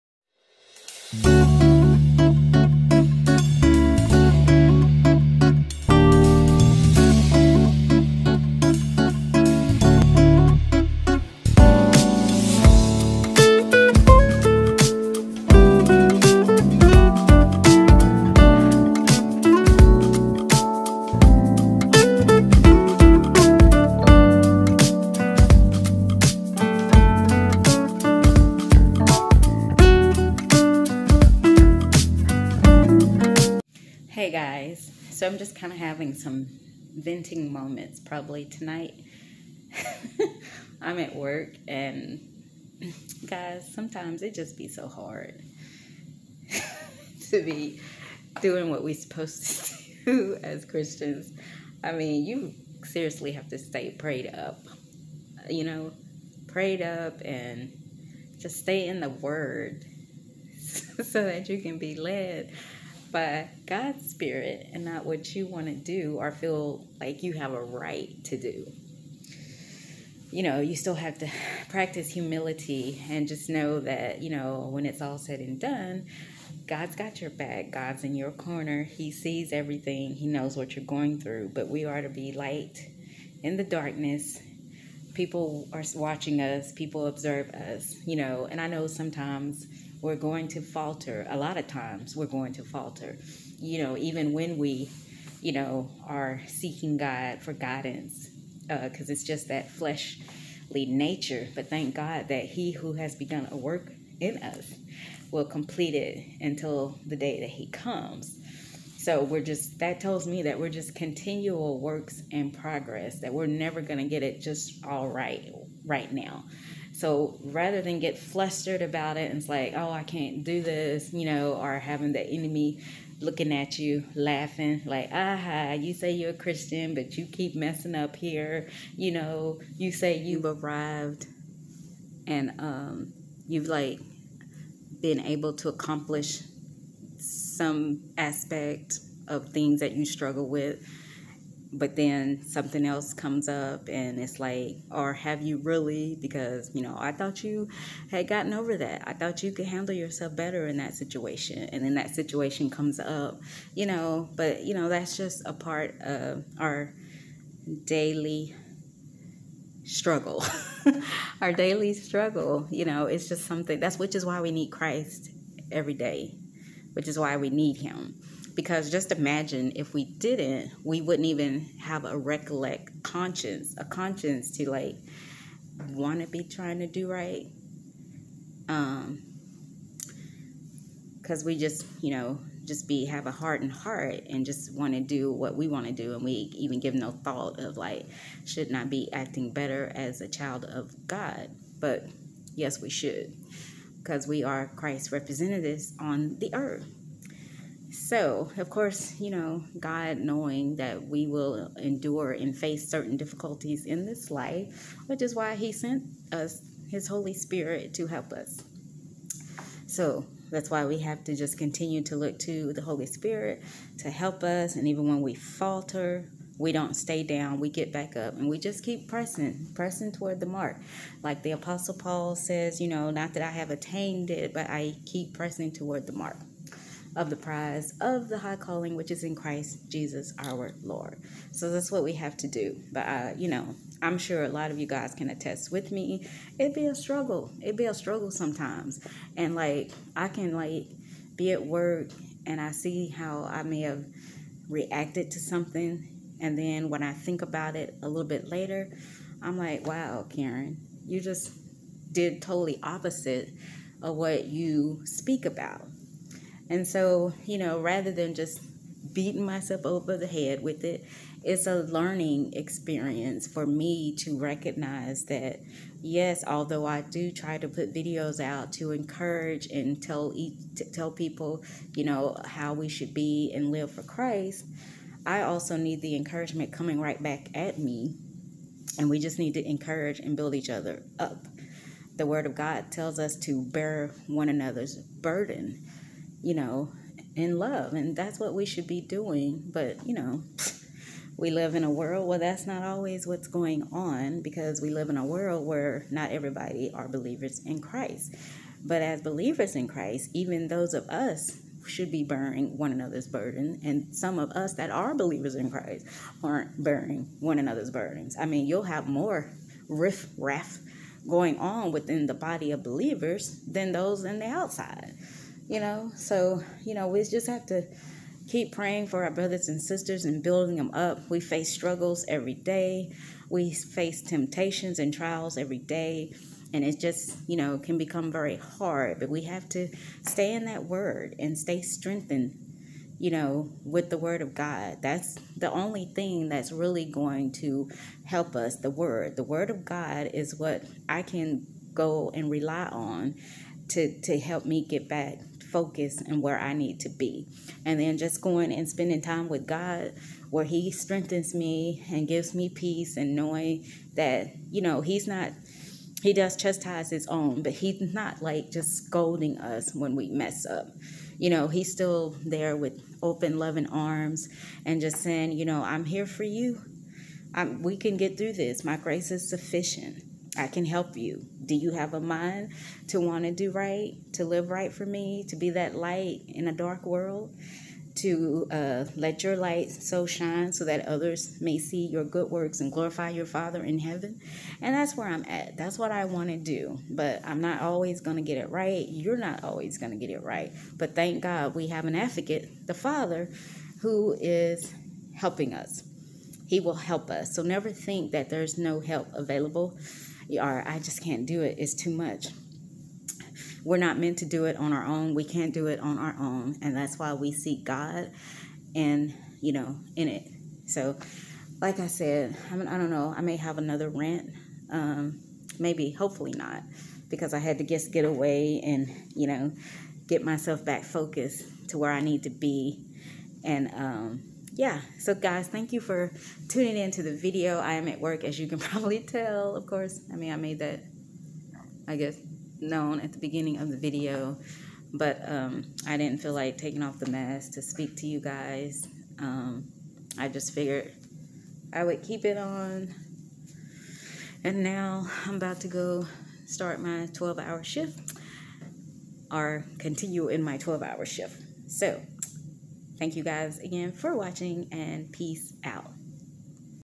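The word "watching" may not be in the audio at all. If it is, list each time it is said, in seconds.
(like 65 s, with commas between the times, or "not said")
85 s, 454 s.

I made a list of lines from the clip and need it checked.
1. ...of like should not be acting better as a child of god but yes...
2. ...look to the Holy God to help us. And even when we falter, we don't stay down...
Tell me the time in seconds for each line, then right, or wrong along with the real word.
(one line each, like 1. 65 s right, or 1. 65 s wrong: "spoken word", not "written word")
1. 187 s right
2. 212 s wrong: "Spirit", not "God".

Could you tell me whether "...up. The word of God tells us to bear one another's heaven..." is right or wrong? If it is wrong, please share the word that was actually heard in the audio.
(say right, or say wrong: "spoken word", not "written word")
wrong: "burden", not "heaven".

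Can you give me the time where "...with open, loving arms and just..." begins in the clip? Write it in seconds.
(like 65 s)
362 s.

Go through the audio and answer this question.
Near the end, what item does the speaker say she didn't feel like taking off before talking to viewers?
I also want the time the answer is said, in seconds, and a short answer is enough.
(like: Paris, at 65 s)
the mask, at 437 s.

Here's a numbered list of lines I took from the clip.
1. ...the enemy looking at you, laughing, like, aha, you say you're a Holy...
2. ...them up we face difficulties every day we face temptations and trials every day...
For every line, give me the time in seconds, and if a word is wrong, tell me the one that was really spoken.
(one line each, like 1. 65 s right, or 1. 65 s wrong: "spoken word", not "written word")
1. 122 s wrong: "Christian", not "Holy"
2. 320 s wrong: "struggles", not "difficulties".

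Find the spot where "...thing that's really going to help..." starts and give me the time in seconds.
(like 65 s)
336 s.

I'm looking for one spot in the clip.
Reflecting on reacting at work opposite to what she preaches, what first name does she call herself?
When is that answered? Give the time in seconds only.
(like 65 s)
250 s.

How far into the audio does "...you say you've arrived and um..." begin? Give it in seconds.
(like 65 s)
129 s.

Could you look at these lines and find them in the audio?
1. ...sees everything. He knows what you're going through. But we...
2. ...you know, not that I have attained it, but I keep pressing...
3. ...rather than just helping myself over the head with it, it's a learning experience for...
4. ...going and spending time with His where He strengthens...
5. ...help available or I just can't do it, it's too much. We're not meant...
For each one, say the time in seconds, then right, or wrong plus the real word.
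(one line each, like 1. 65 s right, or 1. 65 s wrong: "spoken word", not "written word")
1. 79 s right
2. 222 s right
3. 257 s wrong: "beating", not "helping"
4. 348 s wrong: "God", not "His"
5. 398 s right.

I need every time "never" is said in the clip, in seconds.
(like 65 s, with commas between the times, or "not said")
113 s, 397 s.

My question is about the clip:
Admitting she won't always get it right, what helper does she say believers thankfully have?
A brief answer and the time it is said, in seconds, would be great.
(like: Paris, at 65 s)
an advocate, at 392 s.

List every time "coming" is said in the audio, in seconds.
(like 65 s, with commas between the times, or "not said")
276 s.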